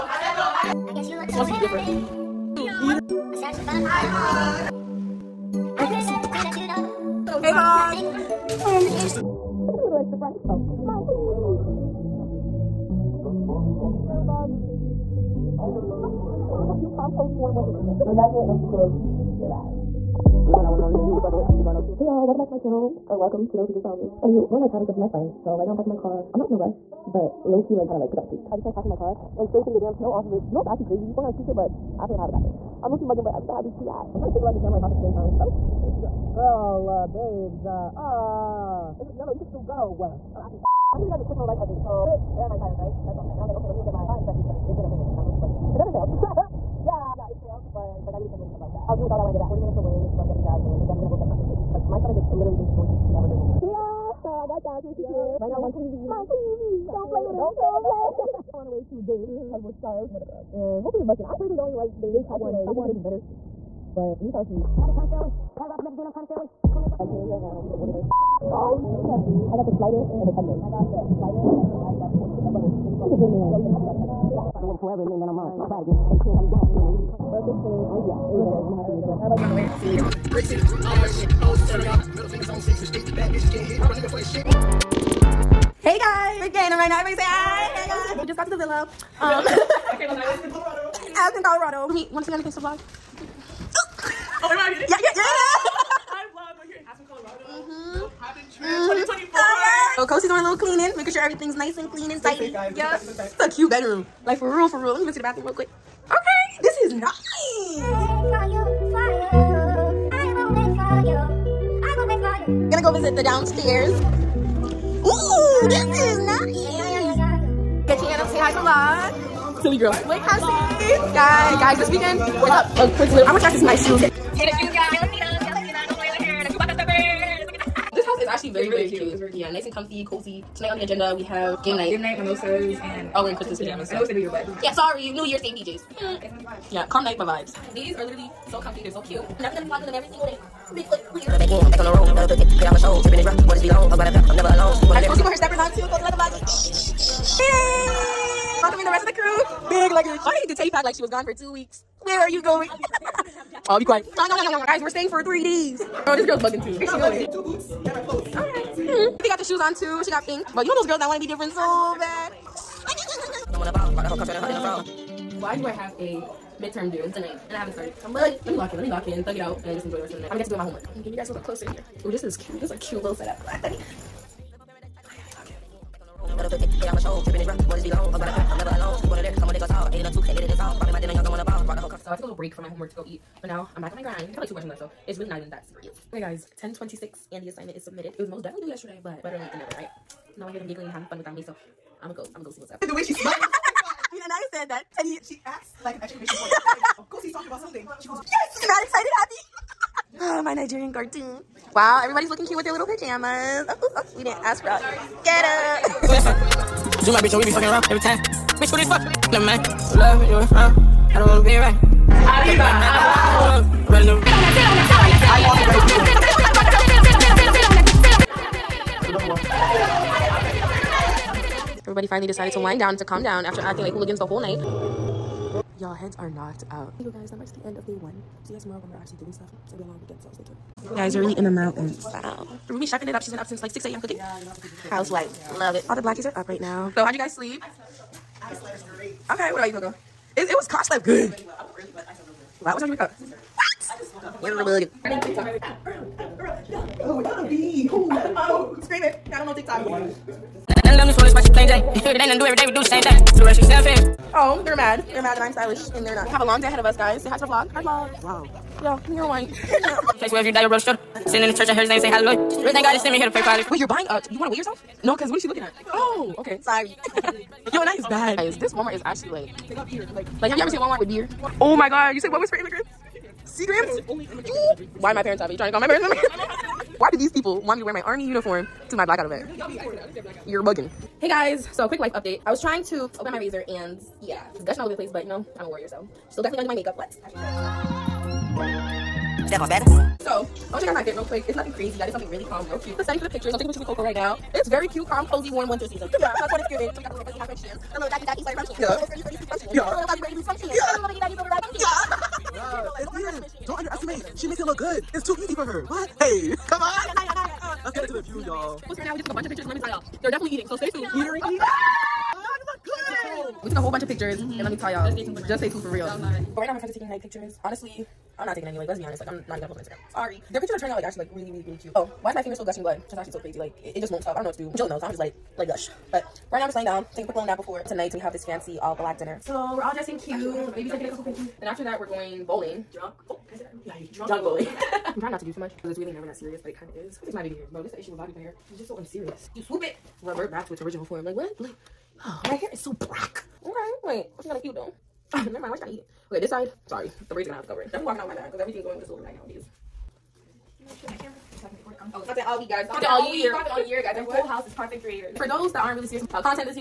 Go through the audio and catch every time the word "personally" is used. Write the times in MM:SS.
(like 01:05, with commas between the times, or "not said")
01:01.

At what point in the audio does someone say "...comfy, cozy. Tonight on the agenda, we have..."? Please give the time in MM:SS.
02:09.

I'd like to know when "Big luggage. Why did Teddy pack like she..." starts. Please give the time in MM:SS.
02:29.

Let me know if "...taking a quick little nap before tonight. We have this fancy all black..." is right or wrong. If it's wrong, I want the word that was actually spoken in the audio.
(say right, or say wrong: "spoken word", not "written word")
right.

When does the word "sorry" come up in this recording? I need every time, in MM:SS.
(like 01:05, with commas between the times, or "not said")
02:14, 04:26, 05:20, 05:46.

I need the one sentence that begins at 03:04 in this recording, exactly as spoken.
I have like two questions left, so it's really not even that serious.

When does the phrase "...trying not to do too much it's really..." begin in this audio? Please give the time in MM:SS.
05:35.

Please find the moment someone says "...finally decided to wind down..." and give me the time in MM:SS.
03:42.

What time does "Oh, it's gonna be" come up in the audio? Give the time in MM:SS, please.
04:07.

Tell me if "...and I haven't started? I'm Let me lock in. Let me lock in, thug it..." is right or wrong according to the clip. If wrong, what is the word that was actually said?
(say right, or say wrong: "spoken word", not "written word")
right.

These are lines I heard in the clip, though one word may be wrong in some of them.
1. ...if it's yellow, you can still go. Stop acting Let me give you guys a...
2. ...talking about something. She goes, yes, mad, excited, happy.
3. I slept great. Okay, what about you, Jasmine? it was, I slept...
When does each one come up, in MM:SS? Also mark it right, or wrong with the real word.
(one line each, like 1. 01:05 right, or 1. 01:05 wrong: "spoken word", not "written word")
1. 00:38 right
2. 03:17 right
3. 03:58 wrong: "Coco", not "Jasmine".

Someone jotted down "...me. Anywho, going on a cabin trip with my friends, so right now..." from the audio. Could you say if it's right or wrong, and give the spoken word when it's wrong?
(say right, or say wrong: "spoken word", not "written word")
right.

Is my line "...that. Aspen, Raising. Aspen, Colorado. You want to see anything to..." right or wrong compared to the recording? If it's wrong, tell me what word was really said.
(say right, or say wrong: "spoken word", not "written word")
wrong: "Colorado", not "Raising".